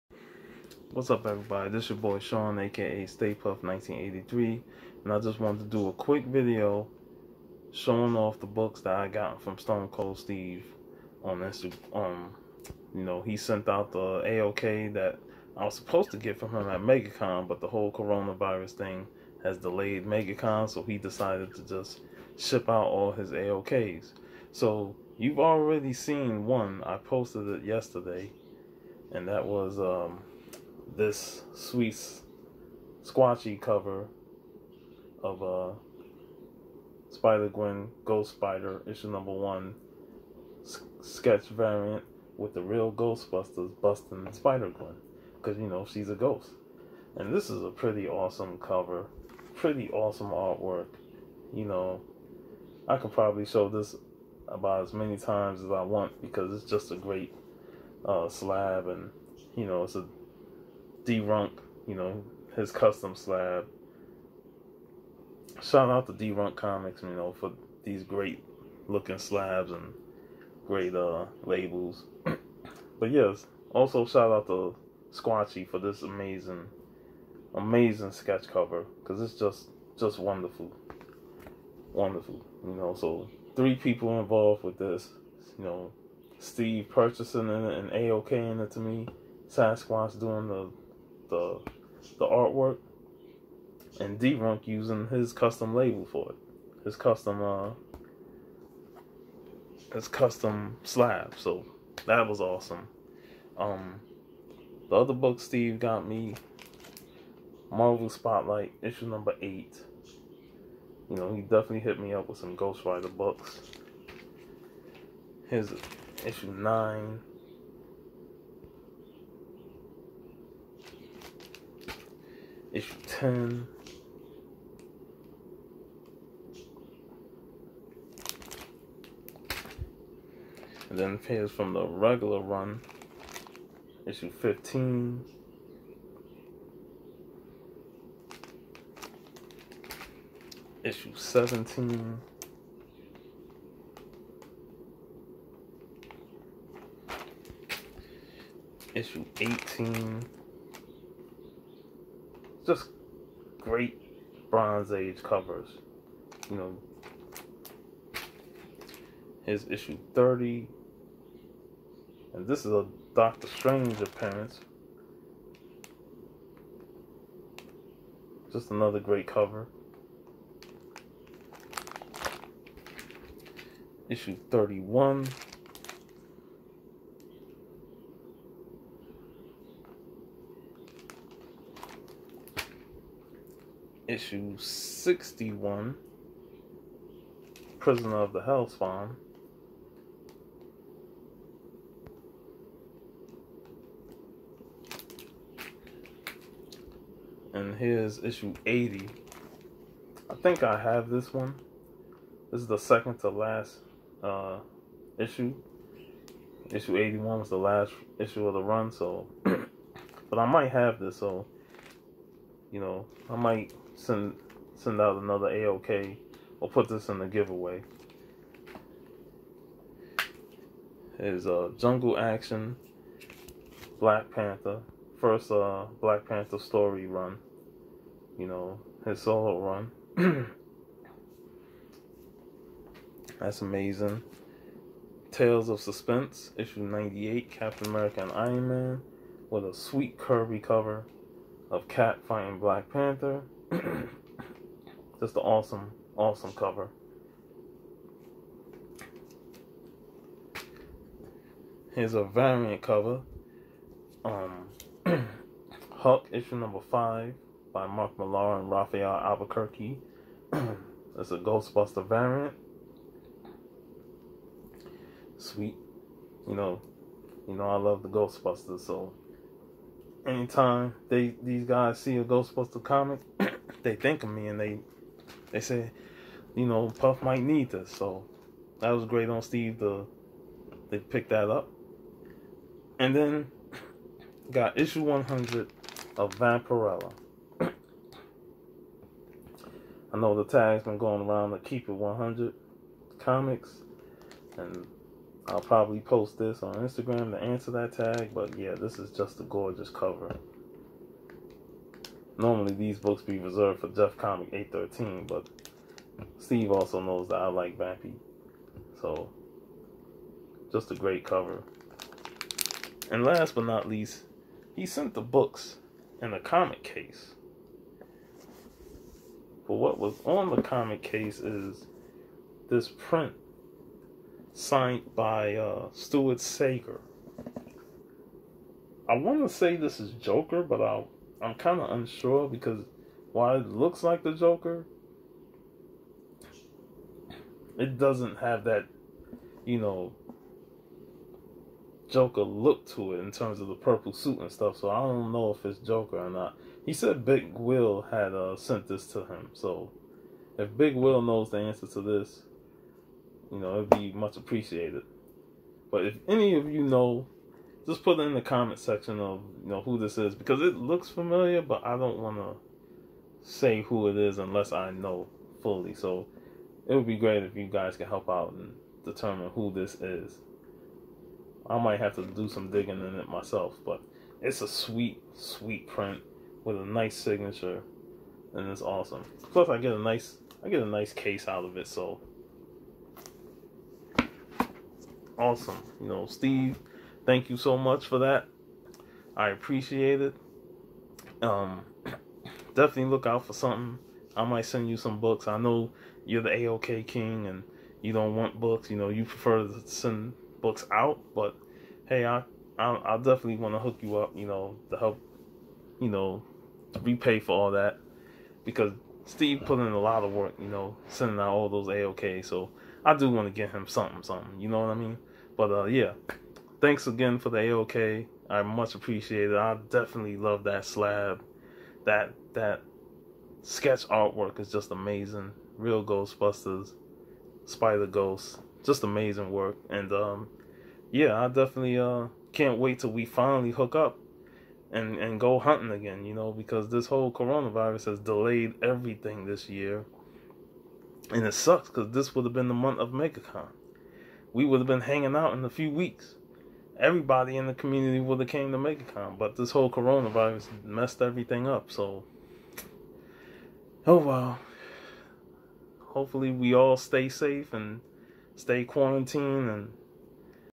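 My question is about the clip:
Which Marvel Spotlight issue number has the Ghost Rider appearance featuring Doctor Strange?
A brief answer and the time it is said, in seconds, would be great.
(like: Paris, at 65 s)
30, at 159 s.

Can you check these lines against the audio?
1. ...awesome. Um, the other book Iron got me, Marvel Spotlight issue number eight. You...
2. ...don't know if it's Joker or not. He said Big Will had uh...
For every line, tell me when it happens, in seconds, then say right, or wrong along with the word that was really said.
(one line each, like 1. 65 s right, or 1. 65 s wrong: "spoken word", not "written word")
1. 102 s wrong: "Steve", not "Iron"
2. 345 s right.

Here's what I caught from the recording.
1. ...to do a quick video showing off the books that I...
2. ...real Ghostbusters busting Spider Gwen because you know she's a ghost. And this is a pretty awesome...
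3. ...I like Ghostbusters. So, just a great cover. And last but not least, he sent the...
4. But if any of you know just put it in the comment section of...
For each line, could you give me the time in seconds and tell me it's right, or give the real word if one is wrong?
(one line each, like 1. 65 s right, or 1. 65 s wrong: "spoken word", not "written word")
1. 5 s right
2. 42 s right
3. 307 s wrong: "Vampy", not "Ghostbusters"
4. 355 s right.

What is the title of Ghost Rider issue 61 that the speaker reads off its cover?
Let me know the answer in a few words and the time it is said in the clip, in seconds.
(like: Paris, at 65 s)
Prisoner of the Hellspawn, at 187 s.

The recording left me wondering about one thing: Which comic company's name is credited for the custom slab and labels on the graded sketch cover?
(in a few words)
D-Runk Comics.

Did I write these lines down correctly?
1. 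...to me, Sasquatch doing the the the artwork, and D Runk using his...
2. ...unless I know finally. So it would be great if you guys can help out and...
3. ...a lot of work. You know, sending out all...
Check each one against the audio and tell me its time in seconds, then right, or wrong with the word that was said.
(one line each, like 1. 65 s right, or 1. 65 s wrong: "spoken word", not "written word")
1. 88 s right
2. 364 s wrong: "fully", not "finally"
3. 409 s right.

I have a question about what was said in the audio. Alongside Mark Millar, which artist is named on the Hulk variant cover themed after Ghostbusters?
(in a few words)
Rafael Albuquerque.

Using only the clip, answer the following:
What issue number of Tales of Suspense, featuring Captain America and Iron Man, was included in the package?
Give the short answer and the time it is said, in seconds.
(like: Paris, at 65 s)
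98, at 236 s.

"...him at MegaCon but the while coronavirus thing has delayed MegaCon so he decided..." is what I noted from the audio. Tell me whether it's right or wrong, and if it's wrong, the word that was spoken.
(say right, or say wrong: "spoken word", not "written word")
wrong: "whole", not "while".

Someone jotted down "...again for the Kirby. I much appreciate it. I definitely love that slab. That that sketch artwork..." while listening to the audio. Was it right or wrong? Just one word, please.
wrong.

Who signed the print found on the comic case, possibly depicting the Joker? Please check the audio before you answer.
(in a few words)
Stuart Sayger.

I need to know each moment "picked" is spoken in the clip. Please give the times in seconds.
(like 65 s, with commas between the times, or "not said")
280 s.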